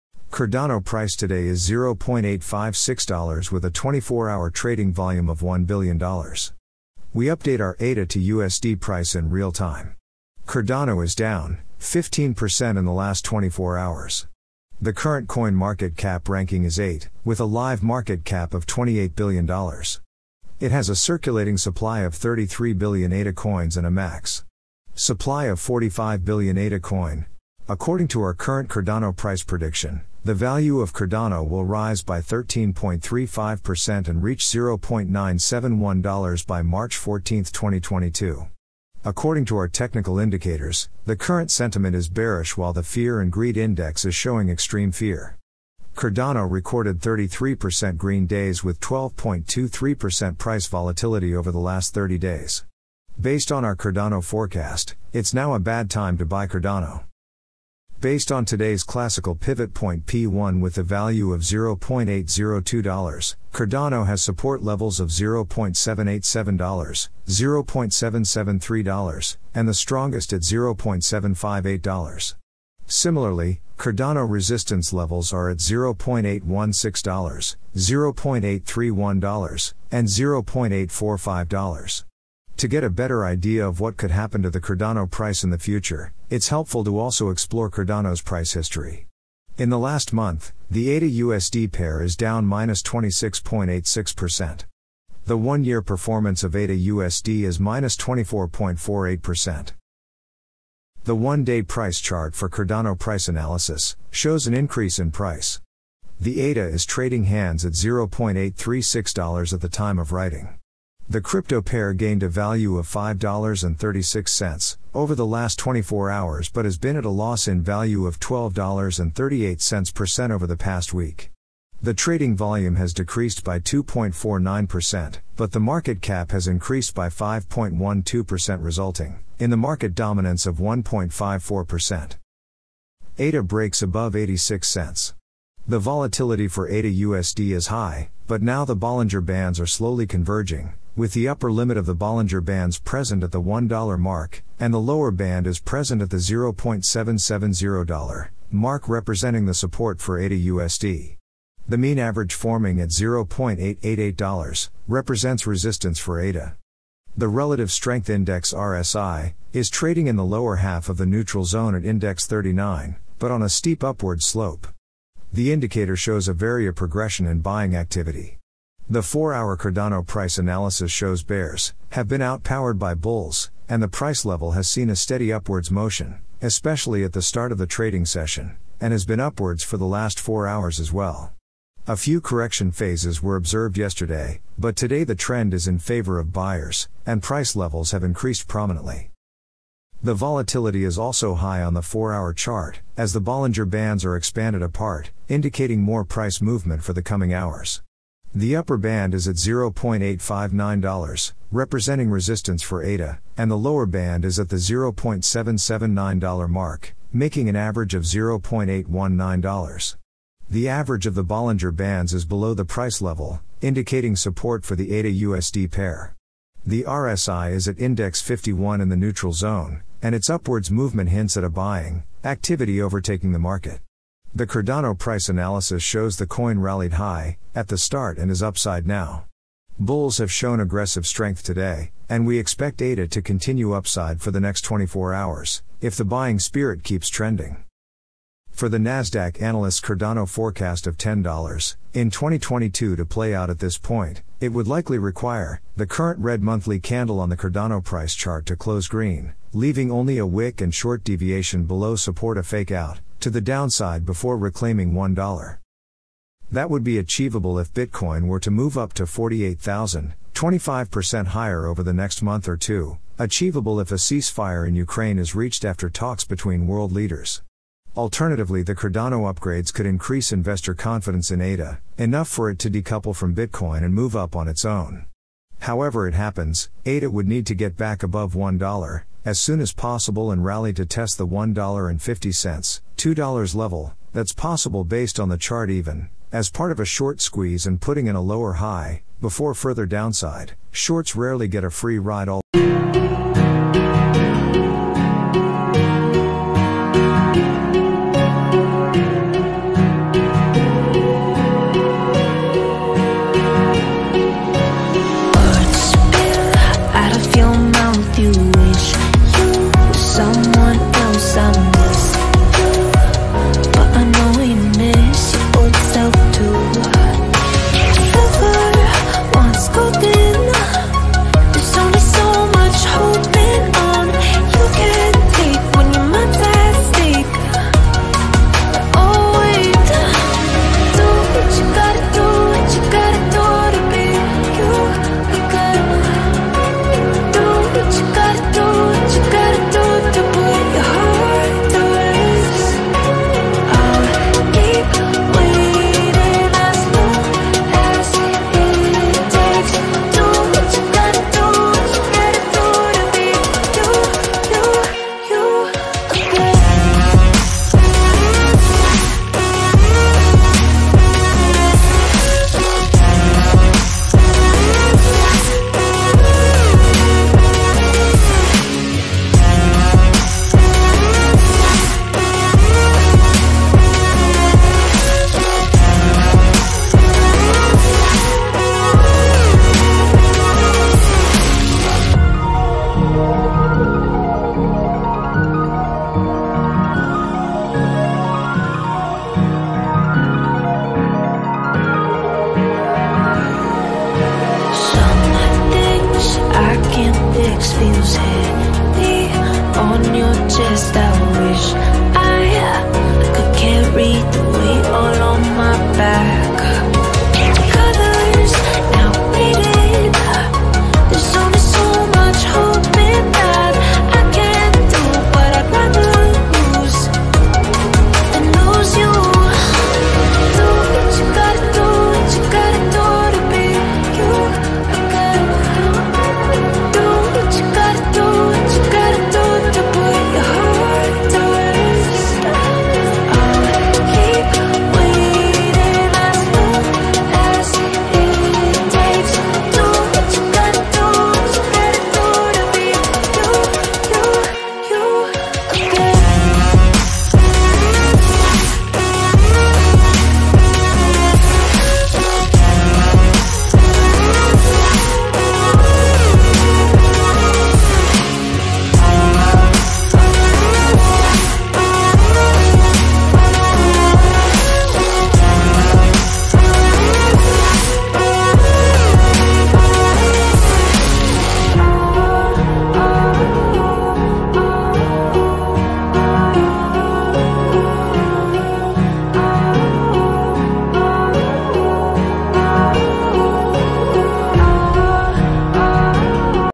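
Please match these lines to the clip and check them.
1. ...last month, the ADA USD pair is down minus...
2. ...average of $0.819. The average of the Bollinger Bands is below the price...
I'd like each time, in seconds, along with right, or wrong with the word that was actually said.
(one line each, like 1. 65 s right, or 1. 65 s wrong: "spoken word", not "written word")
1. 89 s right
2. 207 s right.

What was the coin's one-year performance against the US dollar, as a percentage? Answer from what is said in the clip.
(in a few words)
-24.48%.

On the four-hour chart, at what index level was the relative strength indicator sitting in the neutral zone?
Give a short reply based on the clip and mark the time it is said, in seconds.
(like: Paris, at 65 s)
51, at 217 s.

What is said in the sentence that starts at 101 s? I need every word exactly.
The one day price chart for Cardano price analysis shows an increase in price.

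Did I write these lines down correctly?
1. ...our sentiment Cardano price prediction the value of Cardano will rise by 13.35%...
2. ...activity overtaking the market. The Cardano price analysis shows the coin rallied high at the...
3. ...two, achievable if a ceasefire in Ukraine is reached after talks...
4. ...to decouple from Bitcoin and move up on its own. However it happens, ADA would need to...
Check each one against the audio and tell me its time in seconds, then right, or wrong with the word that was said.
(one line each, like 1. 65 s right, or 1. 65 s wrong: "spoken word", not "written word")
1. 28 s wrong: "current", not "sentiment"
2. 222 s right
3. 262 s right
4. 272 s right.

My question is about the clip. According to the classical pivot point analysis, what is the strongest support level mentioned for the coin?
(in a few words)
$0.758.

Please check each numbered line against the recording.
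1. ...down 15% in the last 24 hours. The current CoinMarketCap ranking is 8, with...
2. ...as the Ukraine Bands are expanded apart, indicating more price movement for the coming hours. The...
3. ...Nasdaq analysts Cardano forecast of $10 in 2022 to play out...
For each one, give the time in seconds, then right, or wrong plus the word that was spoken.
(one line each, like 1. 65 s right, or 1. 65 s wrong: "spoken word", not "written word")
1. 11 s right
2. 192 s wrong: "Bollinger", not "Ukraine"
3. 238 s right.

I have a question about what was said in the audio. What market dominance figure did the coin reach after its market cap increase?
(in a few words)
1.54%.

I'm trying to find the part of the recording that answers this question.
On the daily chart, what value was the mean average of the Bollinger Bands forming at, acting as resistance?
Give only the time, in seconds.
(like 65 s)
152 s.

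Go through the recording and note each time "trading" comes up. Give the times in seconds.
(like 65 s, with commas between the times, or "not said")
4 s, 106 s, 121 s, 159 s, 177 s.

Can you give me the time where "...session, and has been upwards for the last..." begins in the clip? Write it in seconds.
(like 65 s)
178 s.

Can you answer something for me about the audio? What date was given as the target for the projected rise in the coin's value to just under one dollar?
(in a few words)
March 14, 2022.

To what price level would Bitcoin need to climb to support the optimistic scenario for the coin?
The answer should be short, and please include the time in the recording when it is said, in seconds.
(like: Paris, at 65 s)
48,000, at 259 s.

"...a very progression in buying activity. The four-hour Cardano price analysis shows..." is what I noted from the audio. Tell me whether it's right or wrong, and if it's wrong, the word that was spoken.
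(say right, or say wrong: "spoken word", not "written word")
right.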